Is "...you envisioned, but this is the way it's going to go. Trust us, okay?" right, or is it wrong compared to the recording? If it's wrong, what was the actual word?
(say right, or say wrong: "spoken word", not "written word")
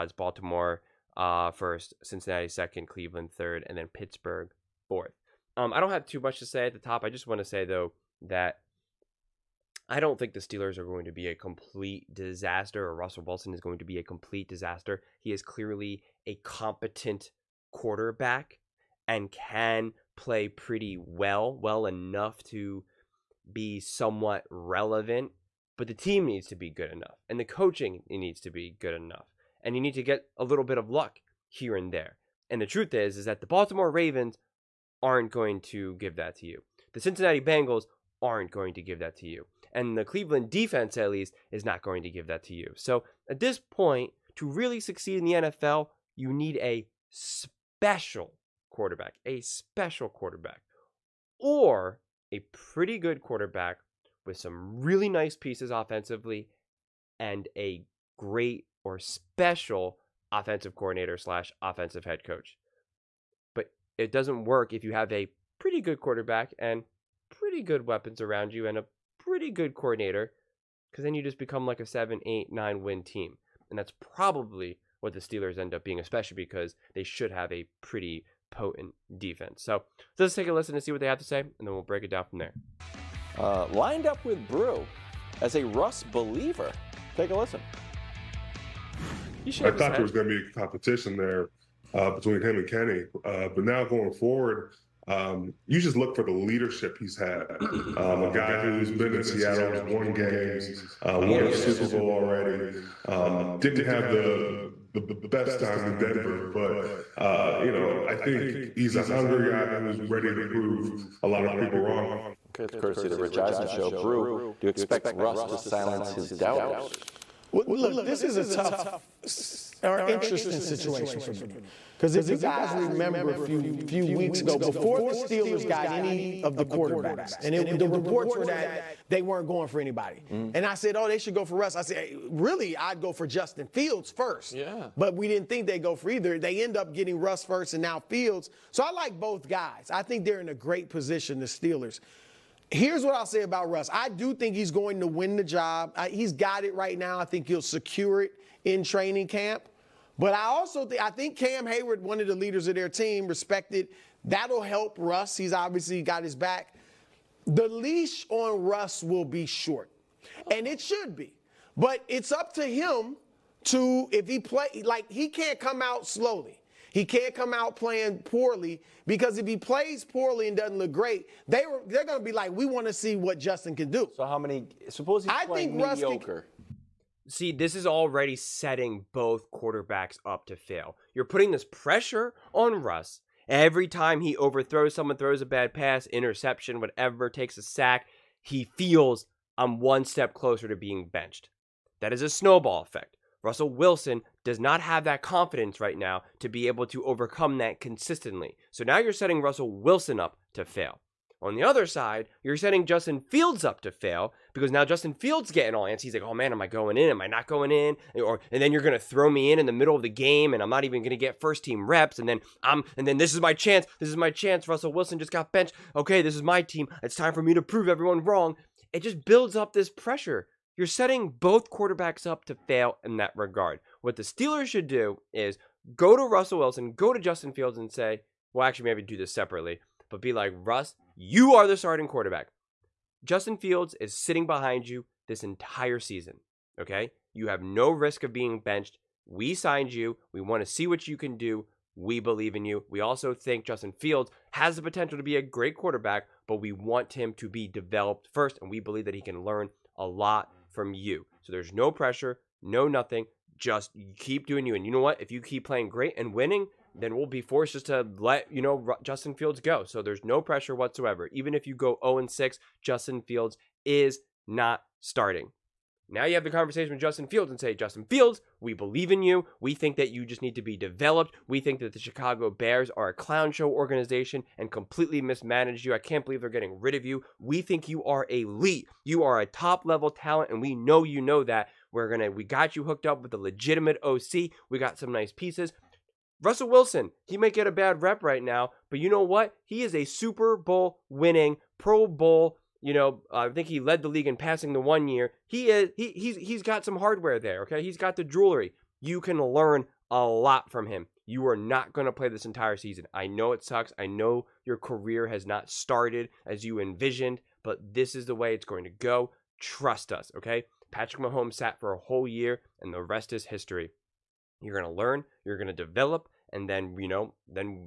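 right.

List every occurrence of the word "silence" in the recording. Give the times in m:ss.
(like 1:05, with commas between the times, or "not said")
1:55.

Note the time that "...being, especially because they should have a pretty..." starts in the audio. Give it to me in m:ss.
1:15.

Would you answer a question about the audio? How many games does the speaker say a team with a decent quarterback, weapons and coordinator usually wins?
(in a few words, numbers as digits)
7, 8, 9.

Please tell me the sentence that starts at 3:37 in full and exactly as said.
It's time for me to prove everyone wrong.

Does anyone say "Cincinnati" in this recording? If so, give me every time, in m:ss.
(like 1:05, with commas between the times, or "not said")
0:02, 0:37.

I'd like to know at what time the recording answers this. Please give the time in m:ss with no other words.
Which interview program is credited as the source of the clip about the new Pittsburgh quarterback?
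1:53.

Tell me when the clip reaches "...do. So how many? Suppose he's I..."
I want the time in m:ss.
2:53.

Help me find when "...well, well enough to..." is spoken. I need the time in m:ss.
0:20.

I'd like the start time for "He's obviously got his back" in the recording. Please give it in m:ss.
2:35.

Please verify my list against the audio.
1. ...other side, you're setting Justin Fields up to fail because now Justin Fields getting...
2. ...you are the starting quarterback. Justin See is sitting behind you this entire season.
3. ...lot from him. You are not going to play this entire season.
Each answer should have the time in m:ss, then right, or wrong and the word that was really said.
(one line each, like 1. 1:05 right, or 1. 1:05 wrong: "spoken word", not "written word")
1. 3:21 right
2. 3:51 wrong: "Fields", not "See"
3. 5:00 right.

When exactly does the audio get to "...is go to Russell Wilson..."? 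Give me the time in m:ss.
3:45.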